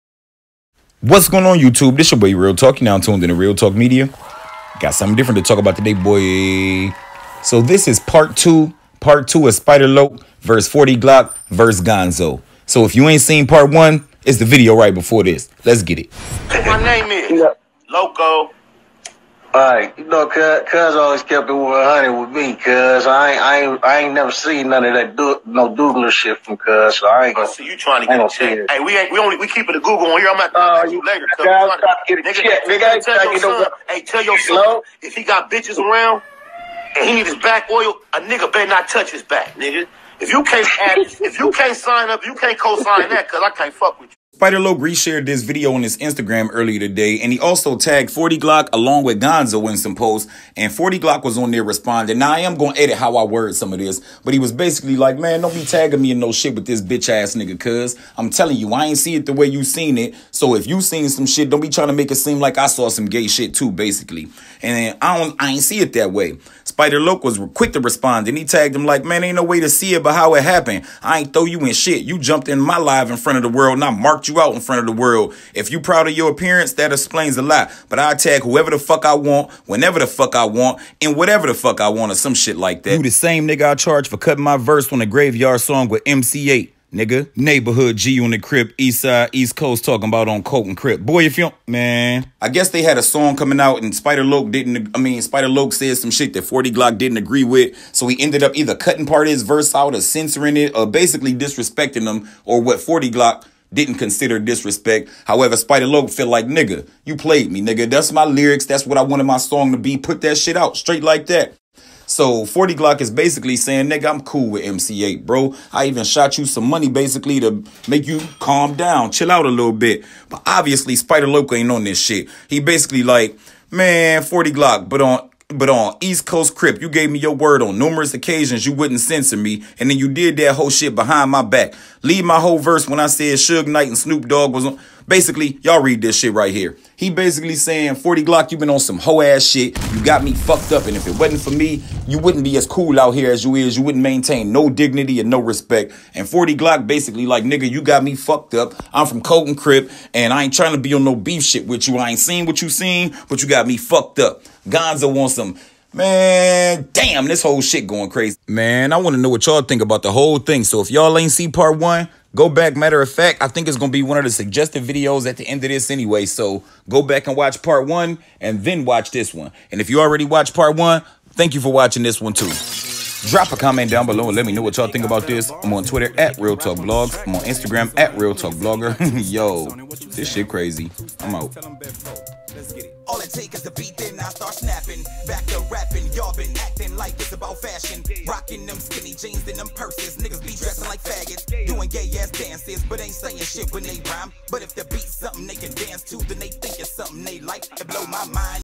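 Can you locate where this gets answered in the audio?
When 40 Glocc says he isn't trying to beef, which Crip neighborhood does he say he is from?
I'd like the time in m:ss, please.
2:29.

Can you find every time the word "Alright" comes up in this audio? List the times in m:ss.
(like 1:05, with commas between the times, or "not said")
0:19.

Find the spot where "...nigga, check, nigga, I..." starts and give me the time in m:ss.
0:32.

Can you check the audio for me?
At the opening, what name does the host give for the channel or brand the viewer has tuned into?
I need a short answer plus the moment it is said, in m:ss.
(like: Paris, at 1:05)
Real Talk Media, at 0:03.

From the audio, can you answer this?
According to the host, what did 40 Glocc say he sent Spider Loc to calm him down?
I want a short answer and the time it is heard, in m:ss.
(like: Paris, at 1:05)
Some money, at 1:56.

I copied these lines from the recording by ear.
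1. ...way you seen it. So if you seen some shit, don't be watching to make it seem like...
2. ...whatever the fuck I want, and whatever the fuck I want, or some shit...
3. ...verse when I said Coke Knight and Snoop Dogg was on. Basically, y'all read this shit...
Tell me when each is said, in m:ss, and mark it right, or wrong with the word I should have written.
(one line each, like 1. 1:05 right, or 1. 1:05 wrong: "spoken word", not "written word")
1. 0:59 wrong: "trying", not "watching"
2. 1:19 wrong: "whenever", not "whatever"
3. 2:12 wrong: "Suge", not "Coke".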